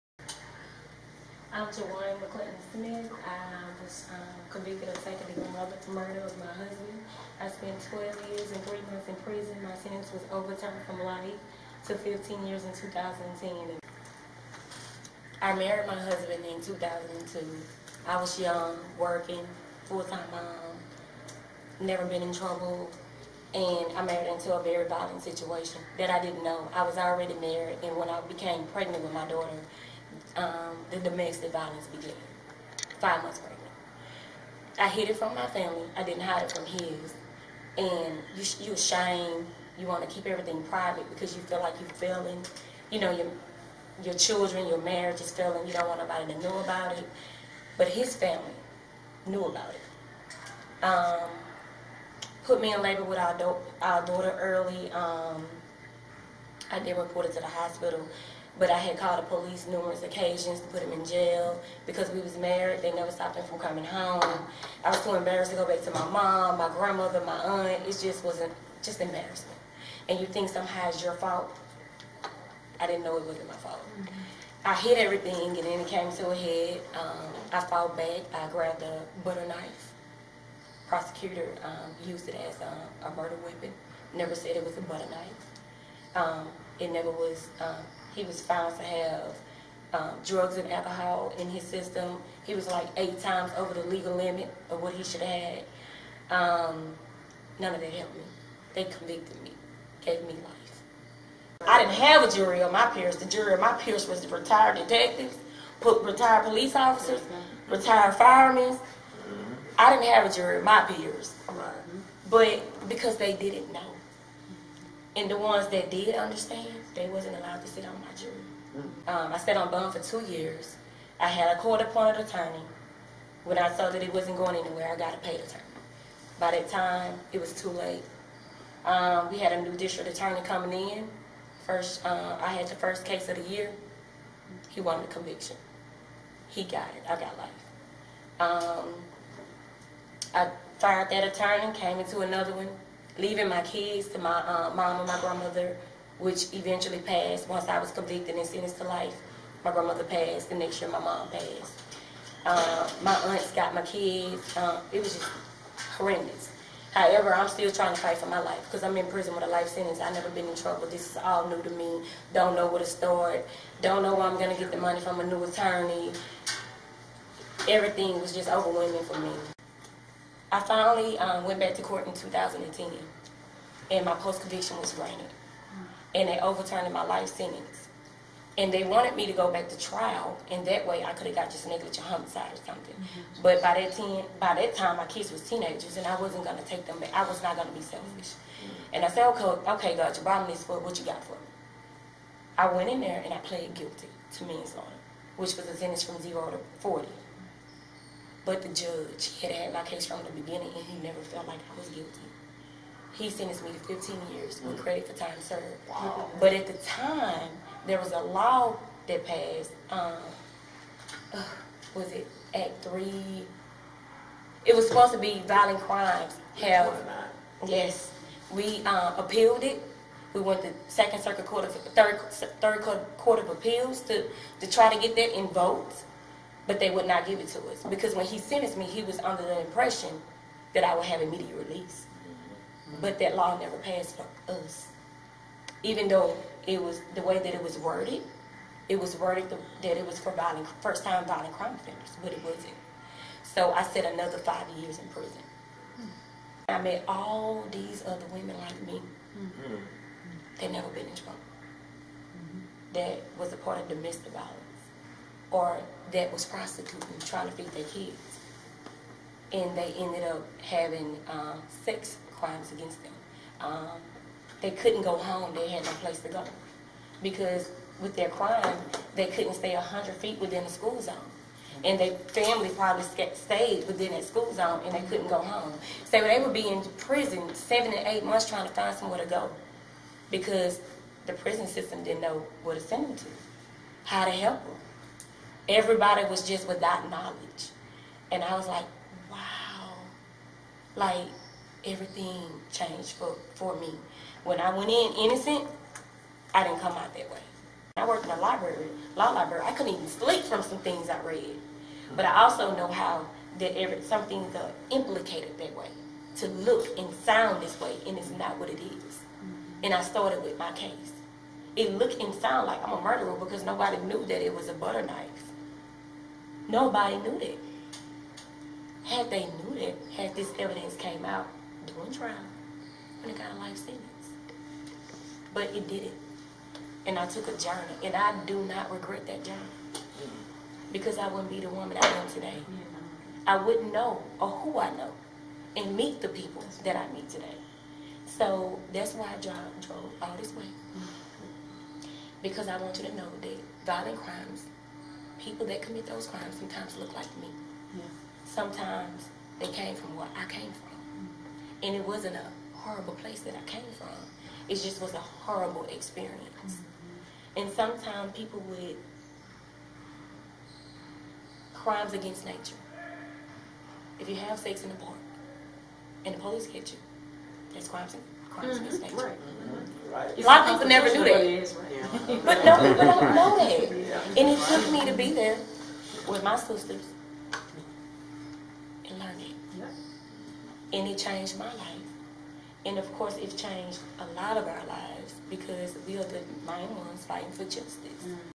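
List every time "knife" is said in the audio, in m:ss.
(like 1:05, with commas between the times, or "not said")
1:19, 1:25, 5:15.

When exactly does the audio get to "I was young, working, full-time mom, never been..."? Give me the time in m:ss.
0:18.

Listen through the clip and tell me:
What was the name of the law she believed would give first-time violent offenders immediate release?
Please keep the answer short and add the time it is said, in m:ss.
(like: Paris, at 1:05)
Act 3, at 3:32.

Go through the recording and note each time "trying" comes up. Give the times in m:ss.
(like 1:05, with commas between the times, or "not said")
2:37, 4:17, 4:38.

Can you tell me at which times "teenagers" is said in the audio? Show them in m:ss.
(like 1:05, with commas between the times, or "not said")
3:05.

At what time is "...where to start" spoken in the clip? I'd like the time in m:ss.
2:42.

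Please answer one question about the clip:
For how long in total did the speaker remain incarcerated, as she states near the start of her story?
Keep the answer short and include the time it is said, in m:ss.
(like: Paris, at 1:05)
12 years and 3 months, at 0:07.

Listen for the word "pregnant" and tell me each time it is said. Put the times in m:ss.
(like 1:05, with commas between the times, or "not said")
0:28, 0:33.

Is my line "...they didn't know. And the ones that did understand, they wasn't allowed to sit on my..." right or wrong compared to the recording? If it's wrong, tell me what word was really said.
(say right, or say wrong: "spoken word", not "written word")
right.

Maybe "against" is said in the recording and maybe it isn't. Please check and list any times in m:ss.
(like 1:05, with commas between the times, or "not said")
4:22, 6:02, 6:08.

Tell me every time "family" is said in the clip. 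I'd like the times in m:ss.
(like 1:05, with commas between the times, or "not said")
0:35, 0:48, 4:32.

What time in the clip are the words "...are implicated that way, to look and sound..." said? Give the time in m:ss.
5:04.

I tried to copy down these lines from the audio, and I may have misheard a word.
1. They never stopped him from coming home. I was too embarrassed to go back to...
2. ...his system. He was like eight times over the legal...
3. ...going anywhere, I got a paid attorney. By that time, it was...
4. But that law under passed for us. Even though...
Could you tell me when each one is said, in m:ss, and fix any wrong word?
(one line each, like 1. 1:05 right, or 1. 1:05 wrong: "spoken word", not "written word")
1. 1:02 right
2. 1:31 right
3. 2:04 right
4. 3:53 wrong: "never", not "under".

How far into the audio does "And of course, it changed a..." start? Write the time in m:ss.
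6:22.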